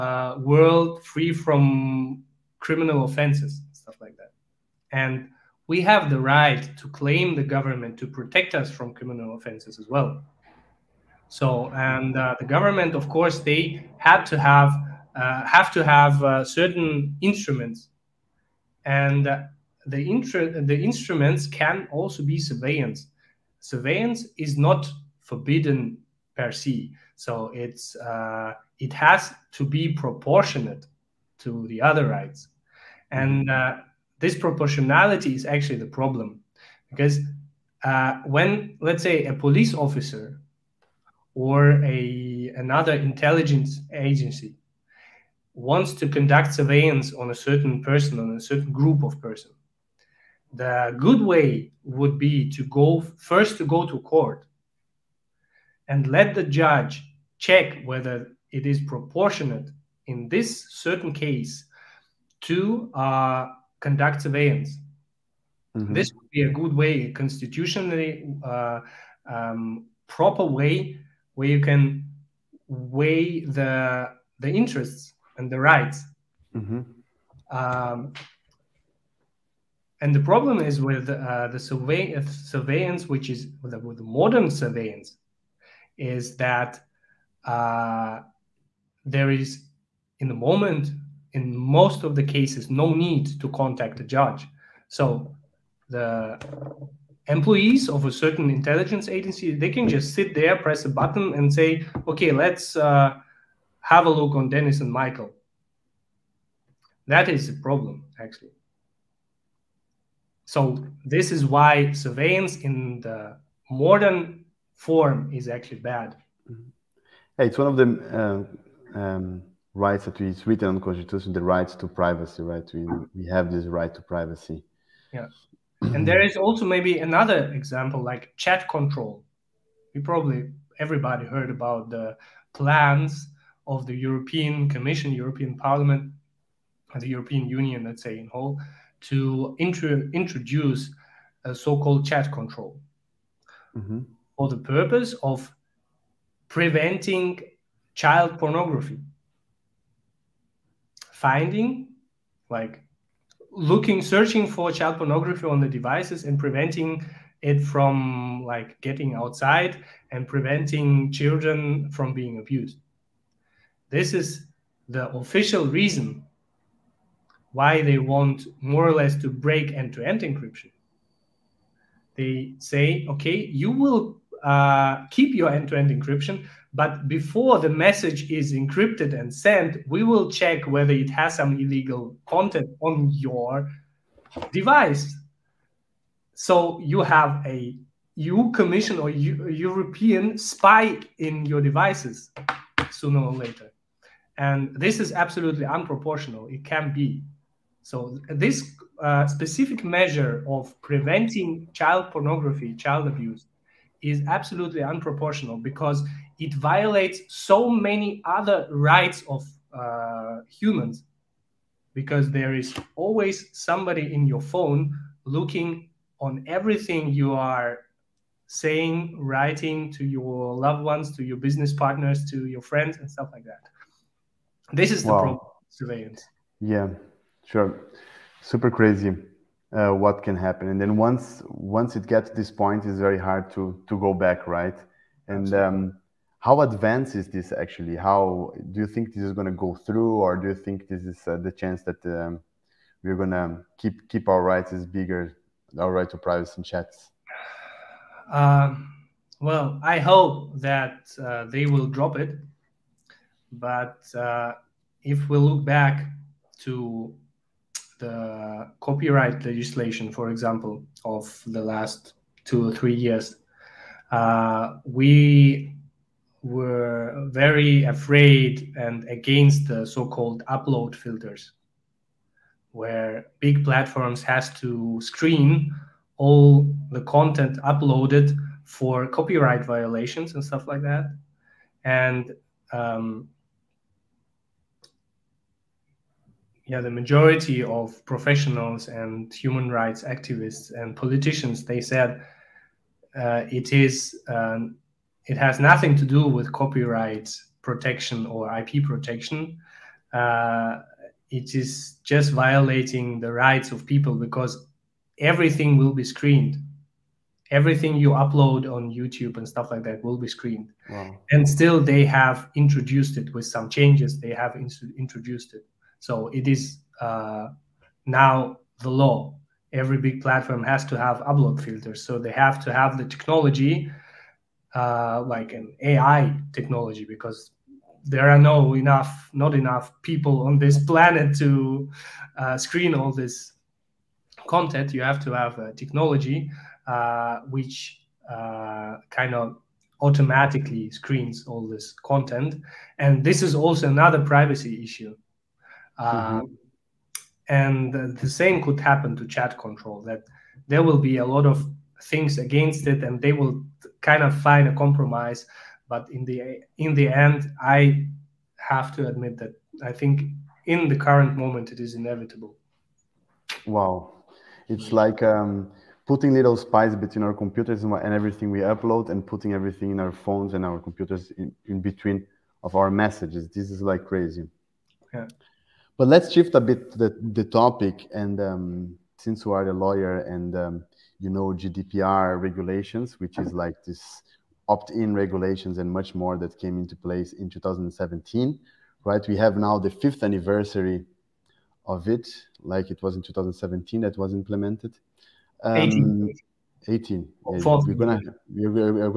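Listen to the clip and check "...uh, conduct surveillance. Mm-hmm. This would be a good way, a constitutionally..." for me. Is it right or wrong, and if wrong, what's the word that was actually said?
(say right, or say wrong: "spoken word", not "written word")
right.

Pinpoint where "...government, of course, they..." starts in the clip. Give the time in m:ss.
0:12.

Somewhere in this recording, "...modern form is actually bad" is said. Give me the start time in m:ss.
1:53.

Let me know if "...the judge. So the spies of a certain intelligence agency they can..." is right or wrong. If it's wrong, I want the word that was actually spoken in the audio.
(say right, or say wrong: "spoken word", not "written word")
wrong: "employees", not "spies".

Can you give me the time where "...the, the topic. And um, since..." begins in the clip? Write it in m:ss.
6:16.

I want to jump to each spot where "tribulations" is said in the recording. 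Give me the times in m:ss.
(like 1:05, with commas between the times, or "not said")
not said.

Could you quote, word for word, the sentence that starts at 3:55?
And um, how advanced is this actually?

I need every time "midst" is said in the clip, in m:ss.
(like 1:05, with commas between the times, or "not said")
not said.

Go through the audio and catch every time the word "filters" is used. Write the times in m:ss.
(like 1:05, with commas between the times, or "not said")
4:30, 5:21.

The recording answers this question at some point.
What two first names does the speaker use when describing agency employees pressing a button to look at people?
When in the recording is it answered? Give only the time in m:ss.
1:44.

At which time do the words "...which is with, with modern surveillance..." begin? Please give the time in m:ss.
1:23.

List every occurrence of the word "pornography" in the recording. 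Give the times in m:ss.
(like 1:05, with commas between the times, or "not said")
2:28, 2:34, 3:22.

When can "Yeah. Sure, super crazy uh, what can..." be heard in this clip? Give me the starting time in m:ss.
3:46.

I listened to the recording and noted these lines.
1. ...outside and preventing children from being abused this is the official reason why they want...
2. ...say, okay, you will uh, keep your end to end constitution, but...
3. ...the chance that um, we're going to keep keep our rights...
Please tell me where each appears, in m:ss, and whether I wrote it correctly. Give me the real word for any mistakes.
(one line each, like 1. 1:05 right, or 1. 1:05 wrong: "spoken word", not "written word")
1. 2:39 right
2. 2:52 wrong: "encryption", not "constitution"
3. 4:01 right.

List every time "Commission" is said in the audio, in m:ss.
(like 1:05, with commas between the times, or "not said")
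2:14, 3:08.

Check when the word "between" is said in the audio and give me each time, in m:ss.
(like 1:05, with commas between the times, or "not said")
6:06, 6:11.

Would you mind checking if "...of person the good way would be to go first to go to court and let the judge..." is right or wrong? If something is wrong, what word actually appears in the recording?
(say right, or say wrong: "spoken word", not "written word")
right.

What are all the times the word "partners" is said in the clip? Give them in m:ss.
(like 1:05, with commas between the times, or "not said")
3:41.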